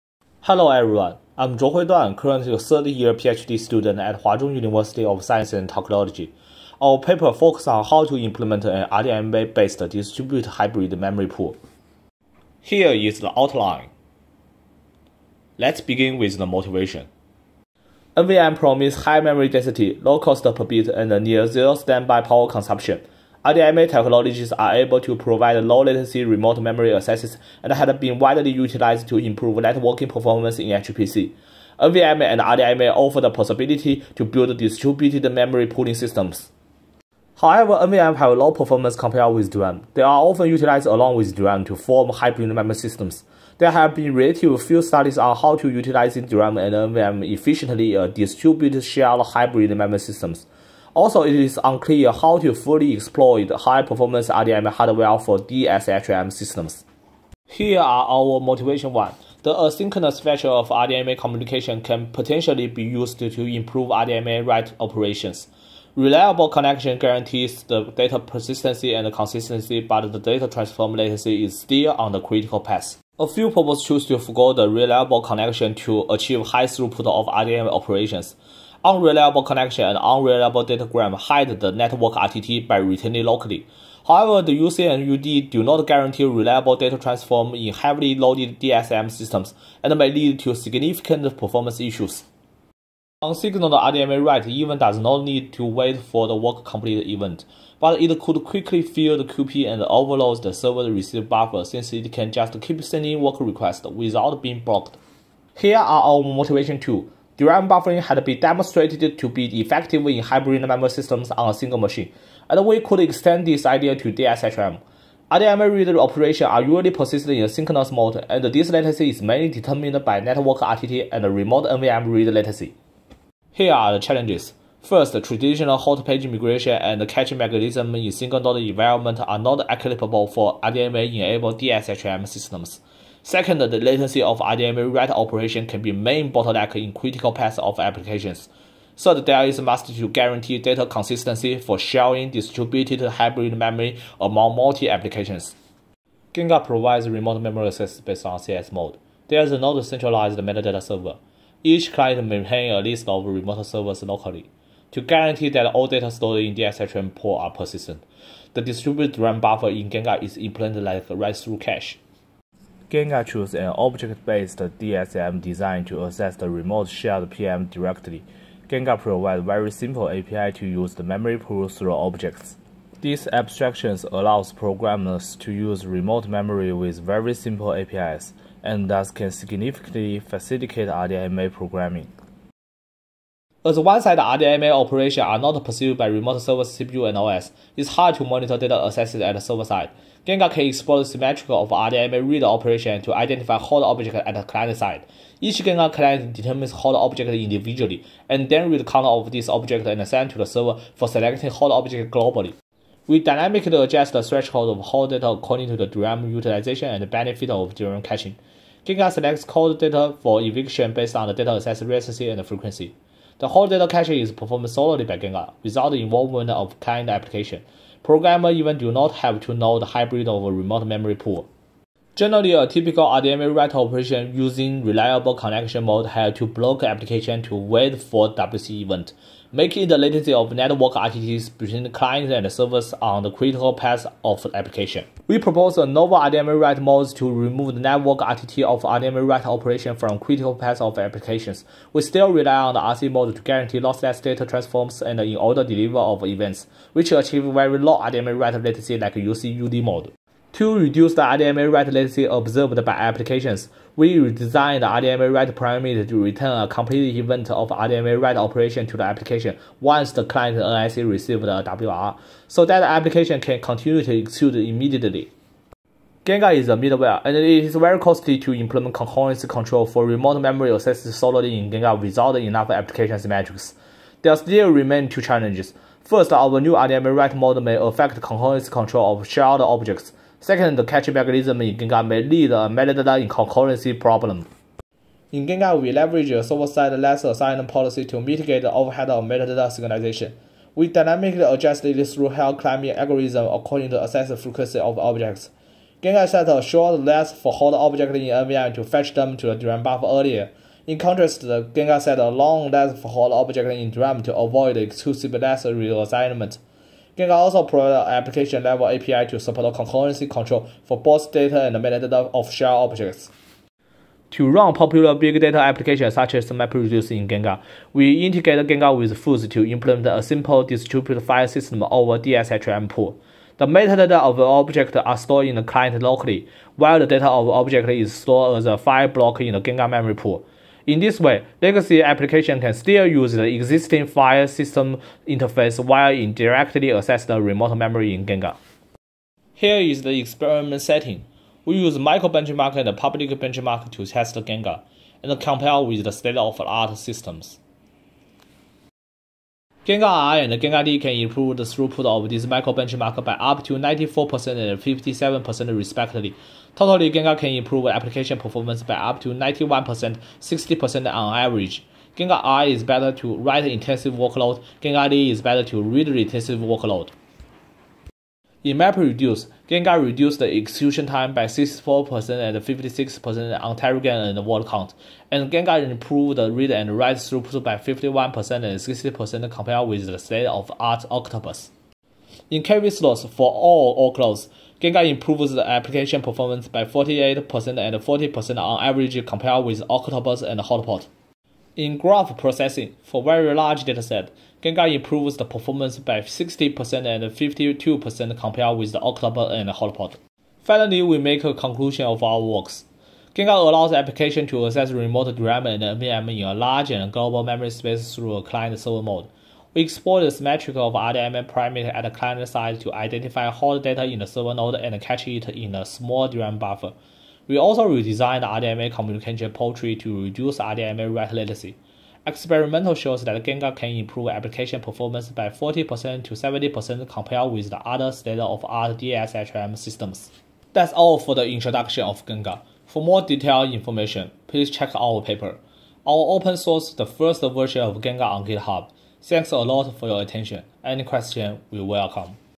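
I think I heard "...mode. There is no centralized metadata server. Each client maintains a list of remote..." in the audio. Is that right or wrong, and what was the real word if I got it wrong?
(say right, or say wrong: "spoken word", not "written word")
right.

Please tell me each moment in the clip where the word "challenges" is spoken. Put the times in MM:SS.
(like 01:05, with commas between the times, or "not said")
02:03, 04:35.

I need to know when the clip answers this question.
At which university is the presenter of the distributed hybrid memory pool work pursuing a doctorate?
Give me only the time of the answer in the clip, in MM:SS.
00:04.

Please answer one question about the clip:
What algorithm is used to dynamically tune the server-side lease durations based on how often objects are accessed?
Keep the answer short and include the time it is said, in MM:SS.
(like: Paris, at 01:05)
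hill climbing, at 04:52.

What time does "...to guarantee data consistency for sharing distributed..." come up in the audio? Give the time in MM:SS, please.
02:19.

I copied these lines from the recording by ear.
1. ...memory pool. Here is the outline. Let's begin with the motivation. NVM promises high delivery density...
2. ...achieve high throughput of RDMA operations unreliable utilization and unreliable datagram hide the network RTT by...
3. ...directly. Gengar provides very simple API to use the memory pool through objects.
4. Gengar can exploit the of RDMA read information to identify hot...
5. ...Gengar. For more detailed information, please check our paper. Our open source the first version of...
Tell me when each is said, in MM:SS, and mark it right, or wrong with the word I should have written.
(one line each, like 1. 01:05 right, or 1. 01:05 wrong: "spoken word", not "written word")
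1. 00:10 wrong: "memory", not "delivery"
2. 01:16 wrong: "connection", not "utilization"
3. 02:47 right
4. 03:10 wrong: "operation", not "information"
5. 07:12 right.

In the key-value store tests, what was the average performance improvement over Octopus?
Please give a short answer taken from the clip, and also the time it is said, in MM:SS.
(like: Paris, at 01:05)
48%, at 06:26.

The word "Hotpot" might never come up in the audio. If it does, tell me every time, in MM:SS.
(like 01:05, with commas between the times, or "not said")
06:30, 06:39.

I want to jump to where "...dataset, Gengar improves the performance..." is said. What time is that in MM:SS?
06:33.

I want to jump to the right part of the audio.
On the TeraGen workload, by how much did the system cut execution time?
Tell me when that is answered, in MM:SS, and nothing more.
06:11.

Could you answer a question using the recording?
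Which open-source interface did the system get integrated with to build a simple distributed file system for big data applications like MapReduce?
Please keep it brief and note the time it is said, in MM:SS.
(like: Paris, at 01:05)
FUSE, at 05:19.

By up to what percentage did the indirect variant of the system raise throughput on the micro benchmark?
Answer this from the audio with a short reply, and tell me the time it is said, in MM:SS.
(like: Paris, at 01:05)
94%, at 05:53.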